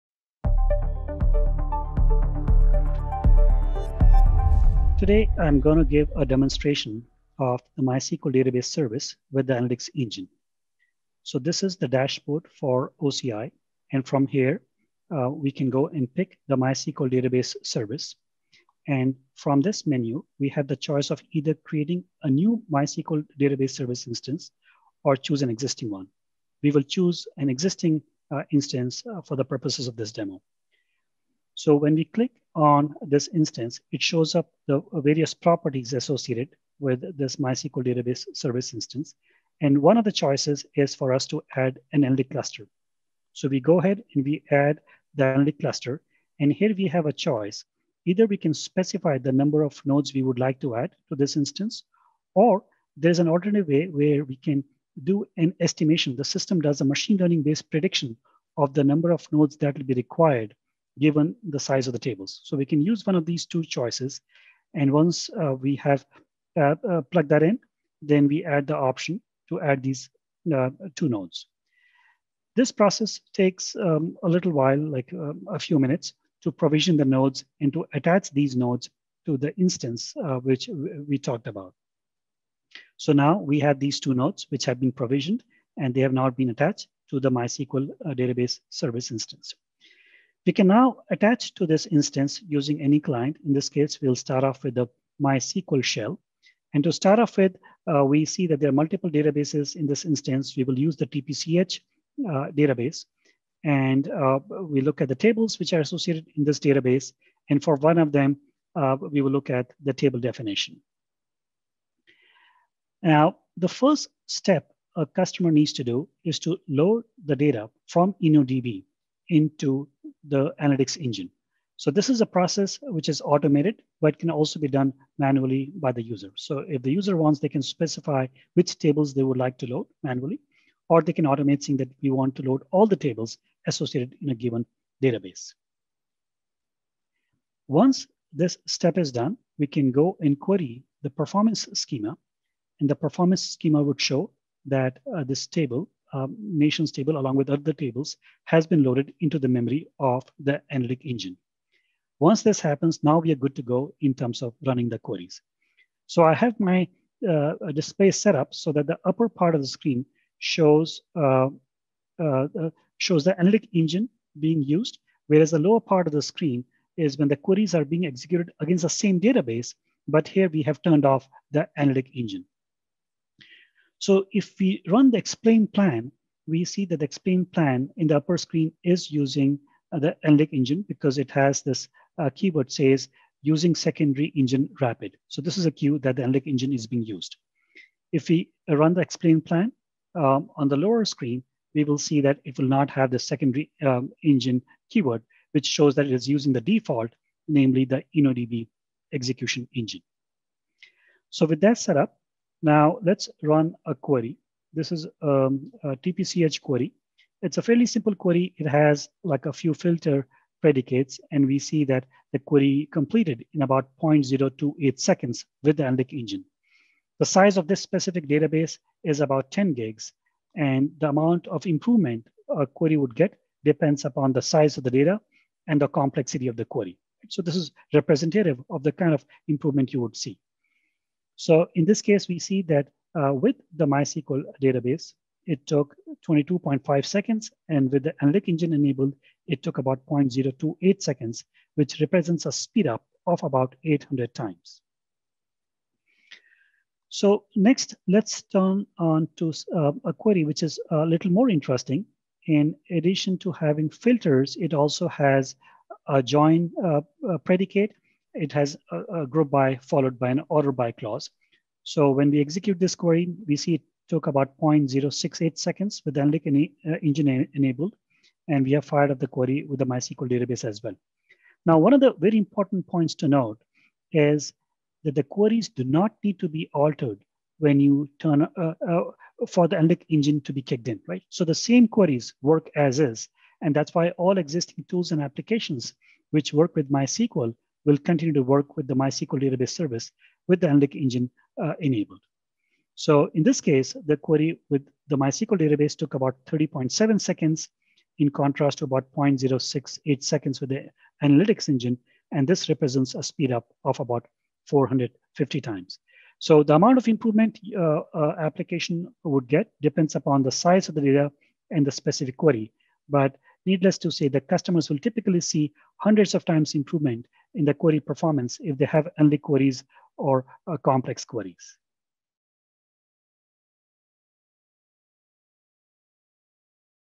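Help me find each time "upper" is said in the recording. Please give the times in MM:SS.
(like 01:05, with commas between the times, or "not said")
02:39, 02:58.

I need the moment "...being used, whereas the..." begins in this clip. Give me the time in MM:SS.
02:44.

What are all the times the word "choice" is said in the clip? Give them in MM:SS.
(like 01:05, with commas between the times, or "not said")
00:20, 00:40, 00:47, 01:03.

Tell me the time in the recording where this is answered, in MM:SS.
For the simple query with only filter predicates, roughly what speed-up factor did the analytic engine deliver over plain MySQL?
04:03.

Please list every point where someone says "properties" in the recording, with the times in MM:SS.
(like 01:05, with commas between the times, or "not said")
00:35.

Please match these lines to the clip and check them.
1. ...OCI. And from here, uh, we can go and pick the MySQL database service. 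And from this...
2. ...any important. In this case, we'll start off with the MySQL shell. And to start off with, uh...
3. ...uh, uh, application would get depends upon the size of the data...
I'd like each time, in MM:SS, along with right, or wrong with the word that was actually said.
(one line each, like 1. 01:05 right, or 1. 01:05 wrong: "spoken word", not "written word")
1. 00:13 right
2. 01:32 wrong: "client", not "important"
3. 05:07 right.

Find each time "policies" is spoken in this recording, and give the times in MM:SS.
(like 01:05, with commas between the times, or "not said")
not said.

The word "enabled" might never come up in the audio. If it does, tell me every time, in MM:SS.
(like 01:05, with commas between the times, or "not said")
03:58, 04:27, 04:51.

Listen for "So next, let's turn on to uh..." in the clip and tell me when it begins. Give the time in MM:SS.
04:07.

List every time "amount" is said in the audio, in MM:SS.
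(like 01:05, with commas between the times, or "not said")
03:41, 05:06.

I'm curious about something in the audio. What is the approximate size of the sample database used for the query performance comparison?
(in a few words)
10 gigs.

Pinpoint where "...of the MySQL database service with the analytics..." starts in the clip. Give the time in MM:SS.
00:07.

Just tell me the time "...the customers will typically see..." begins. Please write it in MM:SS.
05:14.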